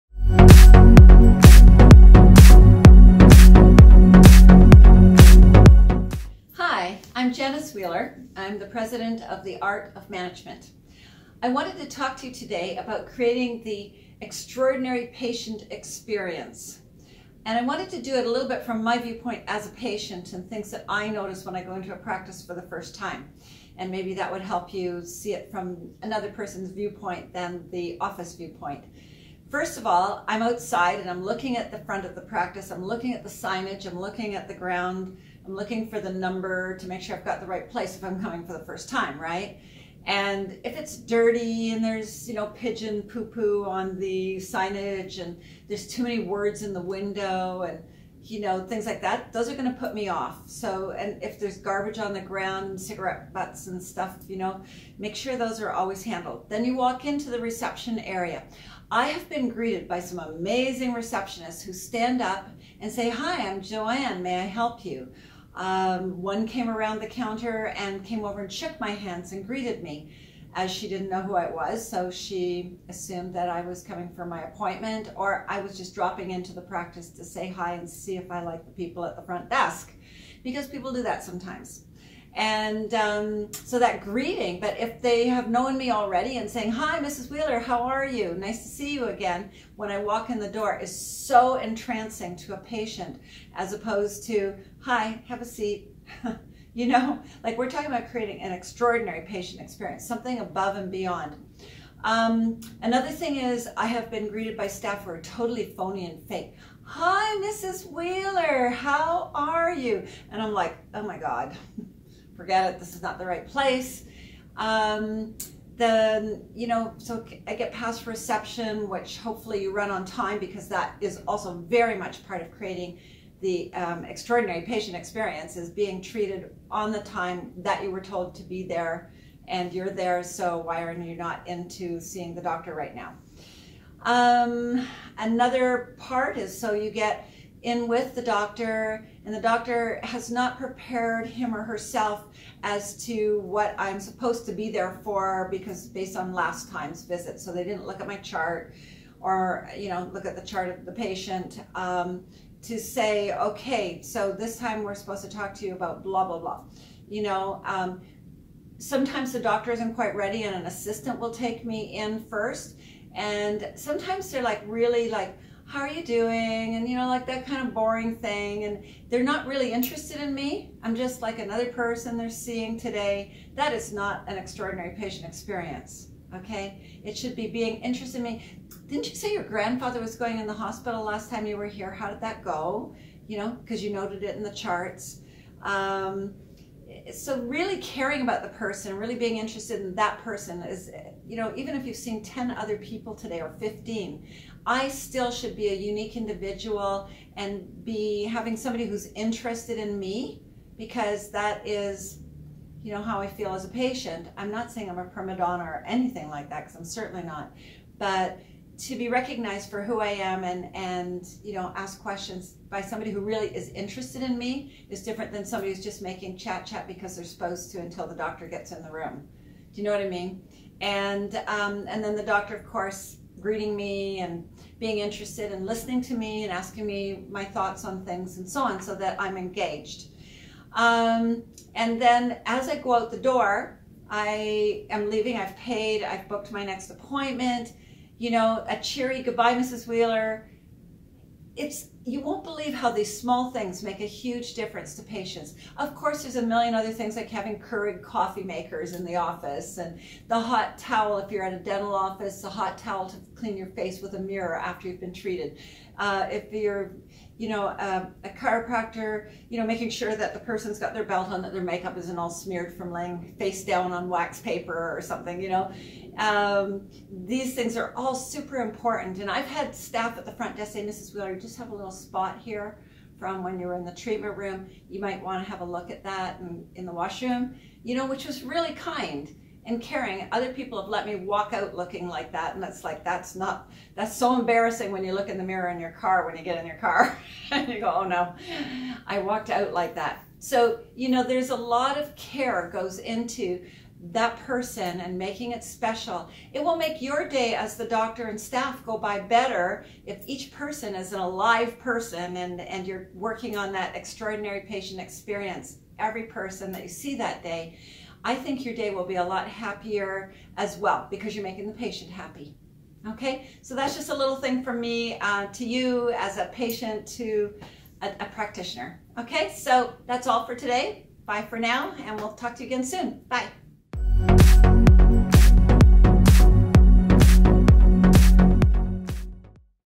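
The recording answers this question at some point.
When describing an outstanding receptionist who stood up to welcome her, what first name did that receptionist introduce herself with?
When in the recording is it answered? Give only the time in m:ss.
1:03.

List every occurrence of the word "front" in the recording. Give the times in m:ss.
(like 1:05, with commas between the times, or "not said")
0:31, 1:19, 4:30.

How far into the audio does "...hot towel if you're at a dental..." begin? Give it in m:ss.
4:10.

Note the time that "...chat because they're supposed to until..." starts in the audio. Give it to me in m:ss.
3:36.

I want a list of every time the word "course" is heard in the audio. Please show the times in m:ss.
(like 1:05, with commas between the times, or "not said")
3:42, 4:05.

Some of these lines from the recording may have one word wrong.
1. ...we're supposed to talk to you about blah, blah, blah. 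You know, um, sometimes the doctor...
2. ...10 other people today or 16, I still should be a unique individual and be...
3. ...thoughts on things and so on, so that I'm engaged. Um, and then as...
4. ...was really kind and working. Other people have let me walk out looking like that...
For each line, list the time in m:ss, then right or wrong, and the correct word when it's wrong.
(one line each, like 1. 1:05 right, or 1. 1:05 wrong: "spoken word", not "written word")
1. 2:34 right
2. 3:12 wrong: "15", not "16"
3. 3:47 right
4. 4:38 wrong: "caring", not "working".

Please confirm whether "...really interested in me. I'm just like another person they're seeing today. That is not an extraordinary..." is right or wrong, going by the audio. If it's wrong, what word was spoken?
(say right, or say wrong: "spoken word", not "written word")
right.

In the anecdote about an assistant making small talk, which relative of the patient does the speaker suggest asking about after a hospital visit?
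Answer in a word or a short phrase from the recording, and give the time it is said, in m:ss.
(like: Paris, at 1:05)
Grandfather, at 2:59.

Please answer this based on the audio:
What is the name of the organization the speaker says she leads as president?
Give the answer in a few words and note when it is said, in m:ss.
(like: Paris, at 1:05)
The Art of Management, at 0:09.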